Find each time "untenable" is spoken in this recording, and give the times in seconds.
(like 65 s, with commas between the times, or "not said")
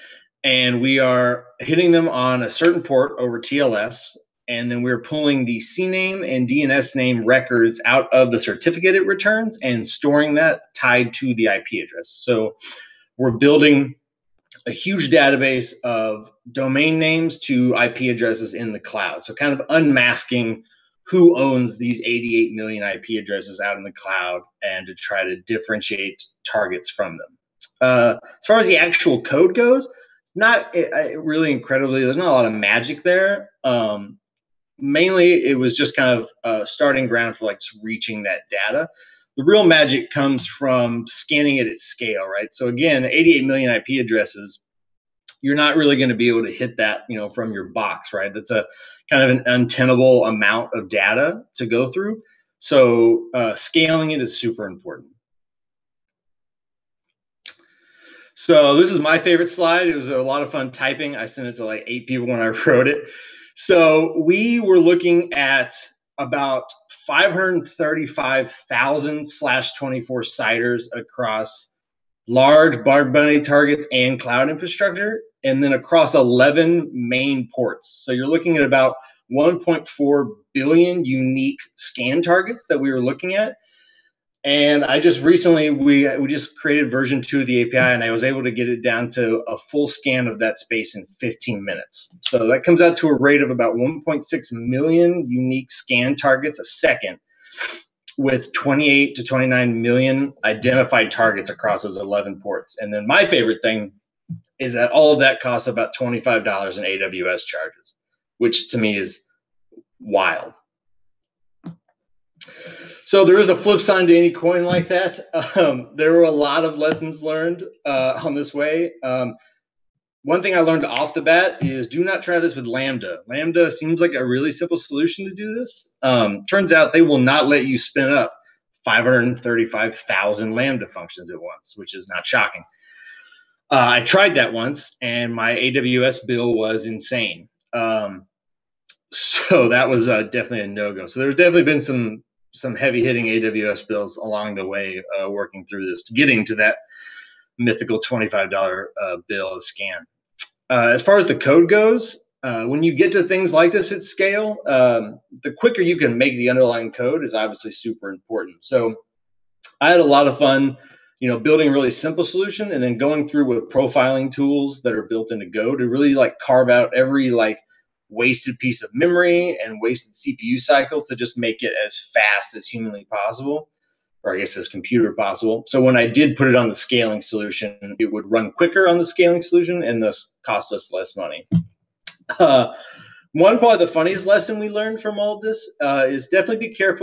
49 s.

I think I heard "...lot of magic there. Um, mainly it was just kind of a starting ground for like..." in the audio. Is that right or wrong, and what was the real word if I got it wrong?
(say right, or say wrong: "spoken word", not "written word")
right.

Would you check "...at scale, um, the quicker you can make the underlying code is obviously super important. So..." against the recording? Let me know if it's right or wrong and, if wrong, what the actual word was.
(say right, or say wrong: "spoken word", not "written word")
right.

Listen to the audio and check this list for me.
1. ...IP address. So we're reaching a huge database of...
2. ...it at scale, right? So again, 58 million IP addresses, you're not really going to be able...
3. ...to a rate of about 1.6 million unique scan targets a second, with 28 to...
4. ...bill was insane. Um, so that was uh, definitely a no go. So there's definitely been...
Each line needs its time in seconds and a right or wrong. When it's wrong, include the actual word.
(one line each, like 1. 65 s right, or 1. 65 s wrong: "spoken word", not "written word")
1. 11 s wrong: "building", not "reaching"
2. 41 s wrong: "88", not "58"
3. 92 s right
4. 136 s right.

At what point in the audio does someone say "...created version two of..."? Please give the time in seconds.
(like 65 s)
86 s.